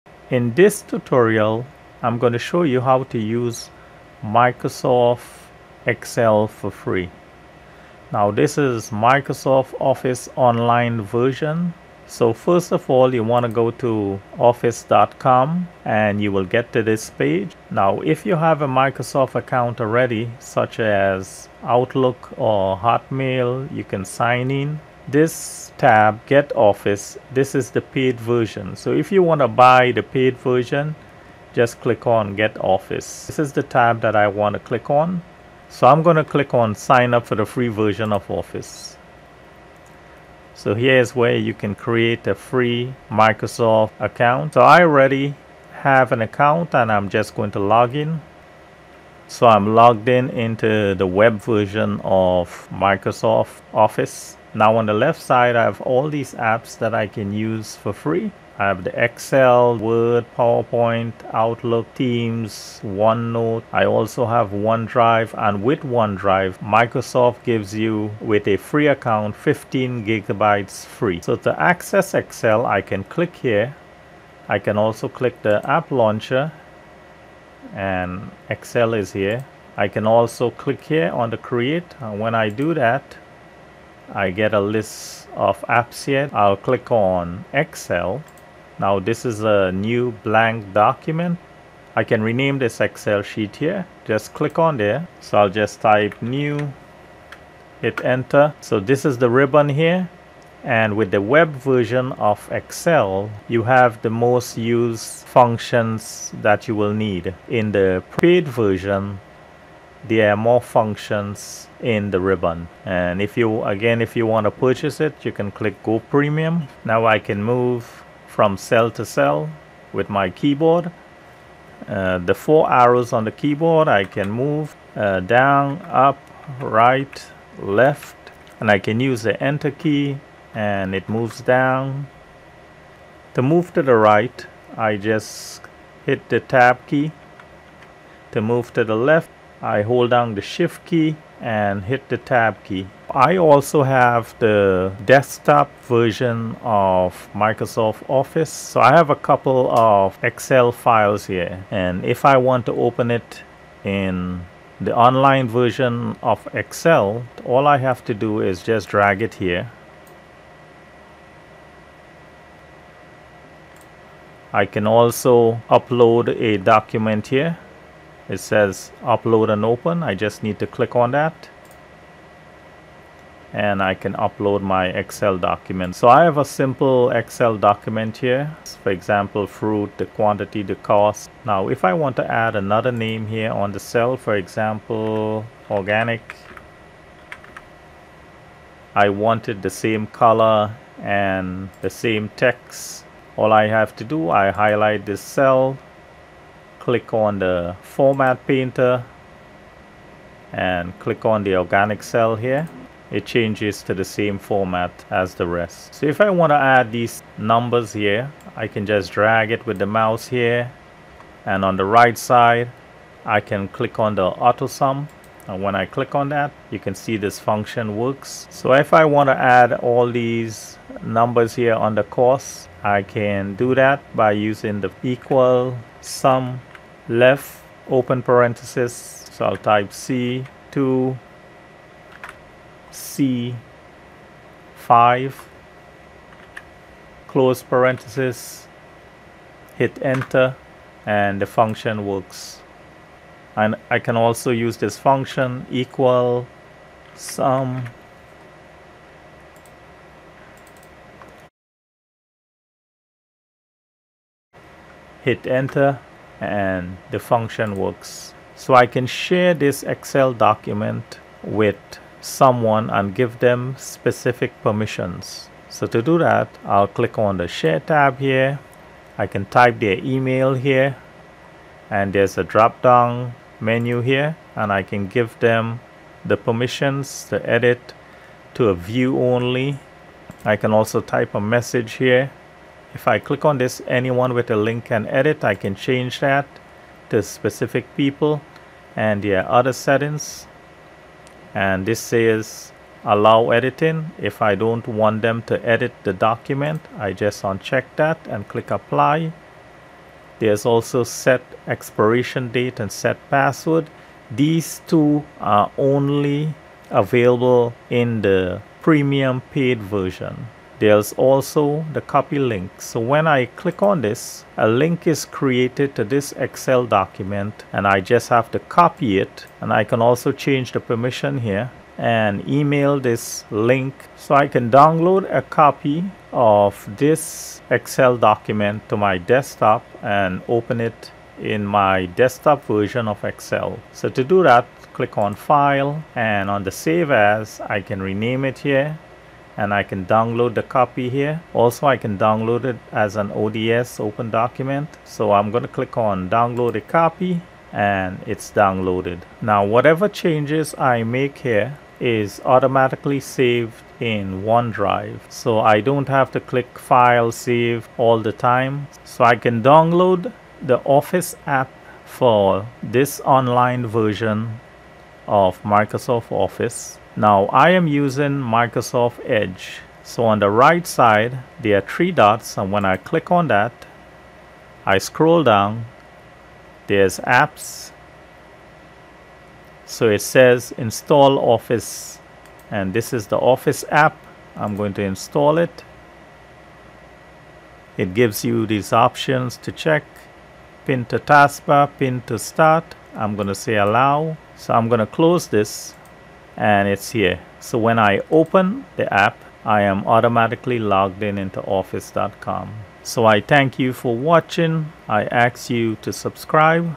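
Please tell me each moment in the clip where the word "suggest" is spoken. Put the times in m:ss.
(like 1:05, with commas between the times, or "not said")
not said.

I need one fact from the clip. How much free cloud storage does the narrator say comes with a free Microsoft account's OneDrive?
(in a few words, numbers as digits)
15 gigabytes.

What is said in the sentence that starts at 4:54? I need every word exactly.
If I don't want them to edit the document, I just uncheck that and click apply.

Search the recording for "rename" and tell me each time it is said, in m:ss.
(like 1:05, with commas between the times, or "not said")
1:32, 5:38.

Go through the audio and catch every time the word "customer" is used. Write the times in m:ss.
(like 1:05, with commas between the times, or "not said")
not said.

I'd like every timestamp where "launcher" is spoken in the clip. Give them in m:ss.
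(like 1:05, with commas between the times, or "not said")
1:15.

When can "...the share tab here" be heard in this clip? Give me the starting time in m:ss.
4:27.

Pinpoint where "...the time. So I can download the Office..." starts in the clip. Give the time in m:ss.
5:58.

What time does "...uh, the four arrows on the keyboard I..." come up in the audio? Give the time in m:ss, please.
2:01.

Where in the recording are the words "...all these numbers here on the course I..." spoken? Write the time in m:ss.
3:39.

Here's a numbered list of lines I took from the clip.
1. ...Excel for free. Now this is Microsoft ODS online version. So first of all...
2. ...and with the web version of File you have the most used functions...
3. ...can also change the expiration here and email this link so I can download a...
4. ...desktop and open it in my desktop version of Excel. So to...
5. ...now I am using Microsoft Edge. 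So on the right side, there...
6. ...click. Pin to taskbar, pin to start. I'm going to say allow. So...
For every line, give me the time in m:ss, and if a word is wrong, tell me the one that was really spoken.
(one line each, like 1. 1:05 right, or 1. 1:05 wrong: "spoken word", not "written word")
1. 0:05 wrong: "Office", not "ODS"
2. 1:40 wrong: "Excel", not "File"
3. 5:19 wrong: "permission", not "expiration"
4. 5:29 right
5. 6:07 right
6. 6:29 wrong: "check", not "click".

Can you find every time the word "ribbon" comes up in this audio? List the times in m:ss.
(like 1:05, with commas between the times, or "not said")
1:39, 1:52.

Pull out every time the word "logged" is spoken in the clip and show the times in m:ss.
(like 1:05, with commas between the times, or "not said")
0:49, 6:40.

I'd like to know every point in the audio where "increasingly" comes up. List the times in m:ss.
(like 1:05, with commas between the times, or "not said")
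not said.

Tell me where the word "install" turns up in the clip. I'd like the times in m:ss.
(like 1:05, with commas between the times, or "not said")
6:20, 6:25.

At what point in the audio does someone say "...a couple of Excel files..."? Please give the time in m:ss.
2:29.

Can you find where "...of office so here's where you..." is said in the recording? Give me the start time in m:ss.
0:38.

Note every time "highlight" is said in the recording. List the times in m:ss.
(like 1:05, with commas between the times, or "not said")
3:14.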